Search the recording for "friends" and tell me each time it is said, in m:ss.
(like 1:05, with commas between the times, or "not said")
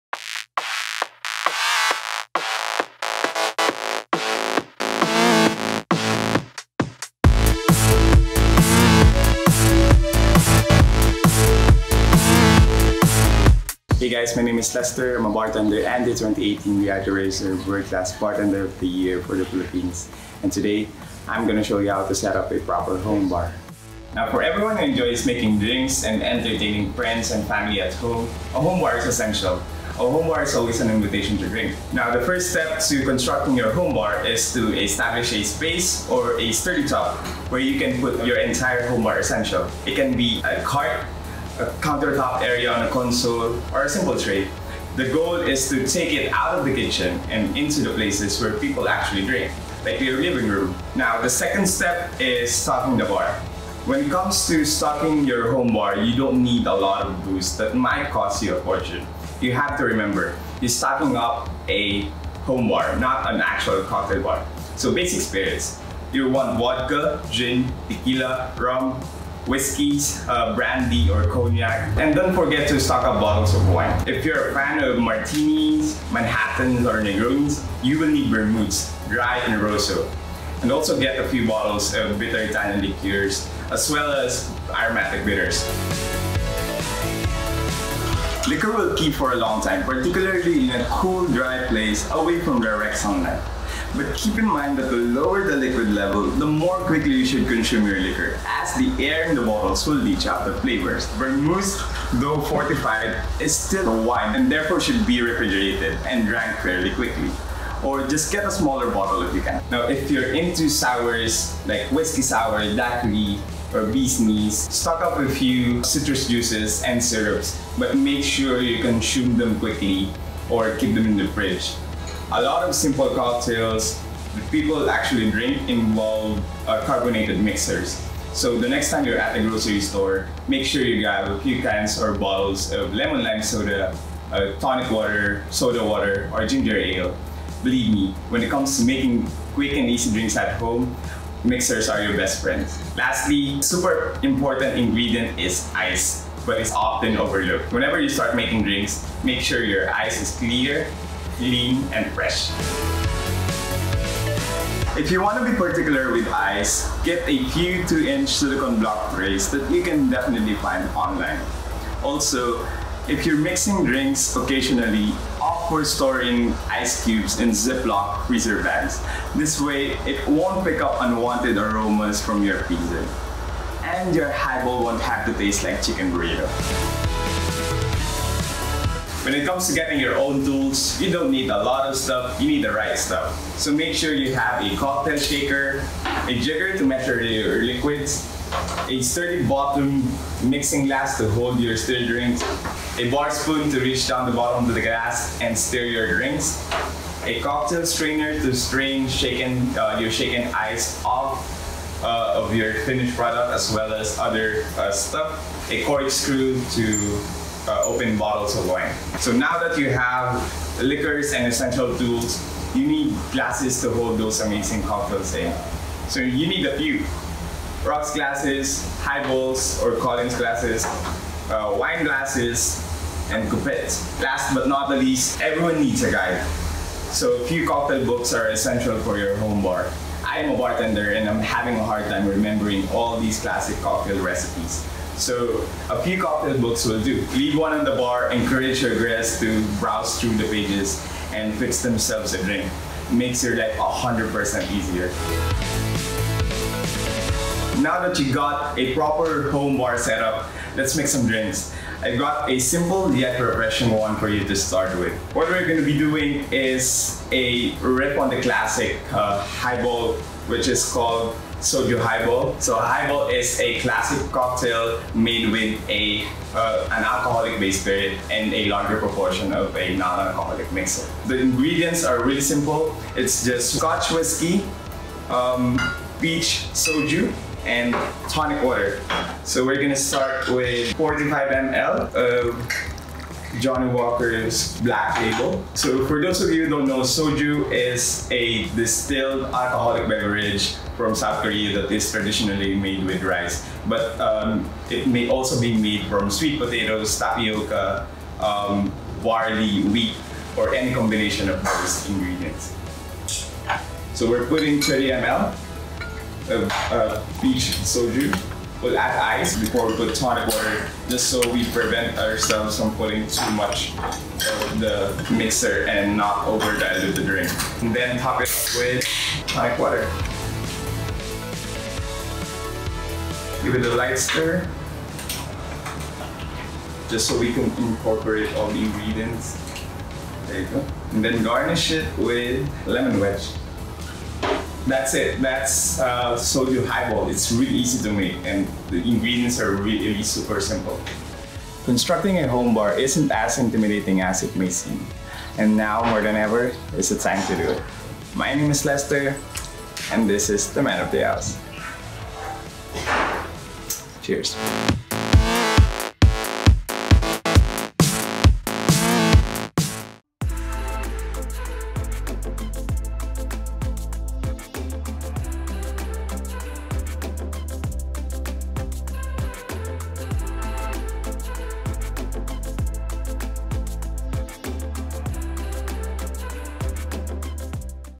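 0:26, 2:22.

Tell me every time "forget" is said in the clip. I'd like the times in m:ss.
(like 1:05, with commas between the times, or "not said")
1:12.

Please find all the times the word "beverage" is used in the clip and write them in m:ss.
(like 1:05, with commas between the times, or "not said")
4:50.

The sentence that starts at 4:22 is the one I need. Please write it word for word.
So highball is a classic cocktail made with a uh, an alcoholic base spirit and a larger proportion of a non-alcoholic mixer.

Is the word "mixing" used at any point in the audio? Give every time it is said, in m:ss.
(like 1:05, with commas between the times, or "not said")
2:43, 3:10.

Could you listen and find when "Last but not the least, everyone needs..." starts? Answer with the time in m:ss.
3:44.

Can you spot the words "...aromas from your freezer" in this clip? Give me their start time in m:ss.
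2:51.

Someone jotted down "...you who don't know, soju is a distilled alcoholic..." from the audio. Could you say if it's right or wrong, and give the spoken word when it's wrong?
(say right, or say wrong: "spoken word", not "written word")
right.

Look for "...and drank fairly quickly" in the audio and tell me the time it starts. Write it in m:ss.
1:46.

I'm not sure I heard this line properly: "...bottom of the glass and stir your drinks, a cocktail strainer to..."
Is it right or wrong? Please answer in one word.
right.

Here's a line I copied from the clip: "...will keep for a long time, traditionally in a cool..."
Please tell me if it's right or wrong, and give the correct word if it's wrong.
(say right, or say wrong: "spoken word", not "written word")
wrong: "particularly", not "traditionally".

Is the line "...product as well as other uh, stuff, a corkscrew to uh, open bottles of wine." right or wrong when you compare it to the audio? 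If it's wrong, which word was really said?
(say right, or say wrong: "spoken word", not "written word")
right.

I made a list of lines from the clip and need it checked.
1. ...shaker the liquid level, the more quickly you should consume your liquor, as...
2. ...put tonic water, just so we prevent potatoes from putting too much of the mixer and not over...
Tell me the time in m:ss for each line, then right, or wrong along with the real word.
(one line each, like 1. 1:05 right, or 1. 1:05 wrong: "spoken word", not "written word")
1. 1:34 wrong: "lower", not "shaker"
2. 5:09 wrong: "ourselves", not "potatoes".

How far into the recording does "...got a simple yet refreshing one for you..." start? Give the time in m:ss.
4:12.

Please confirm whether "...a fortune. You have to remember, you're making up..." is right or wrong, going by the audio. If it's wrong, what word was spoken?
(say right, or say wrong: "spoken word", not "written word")
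wrong: "stocking", not "making".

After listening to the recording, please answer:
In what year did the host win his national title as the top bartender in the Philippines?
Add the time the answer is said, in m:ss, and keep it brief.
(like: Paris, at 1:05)
2018, at 0:16.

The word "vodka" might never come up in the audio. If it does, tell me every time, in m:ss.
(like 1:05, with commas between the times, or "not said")
1:06.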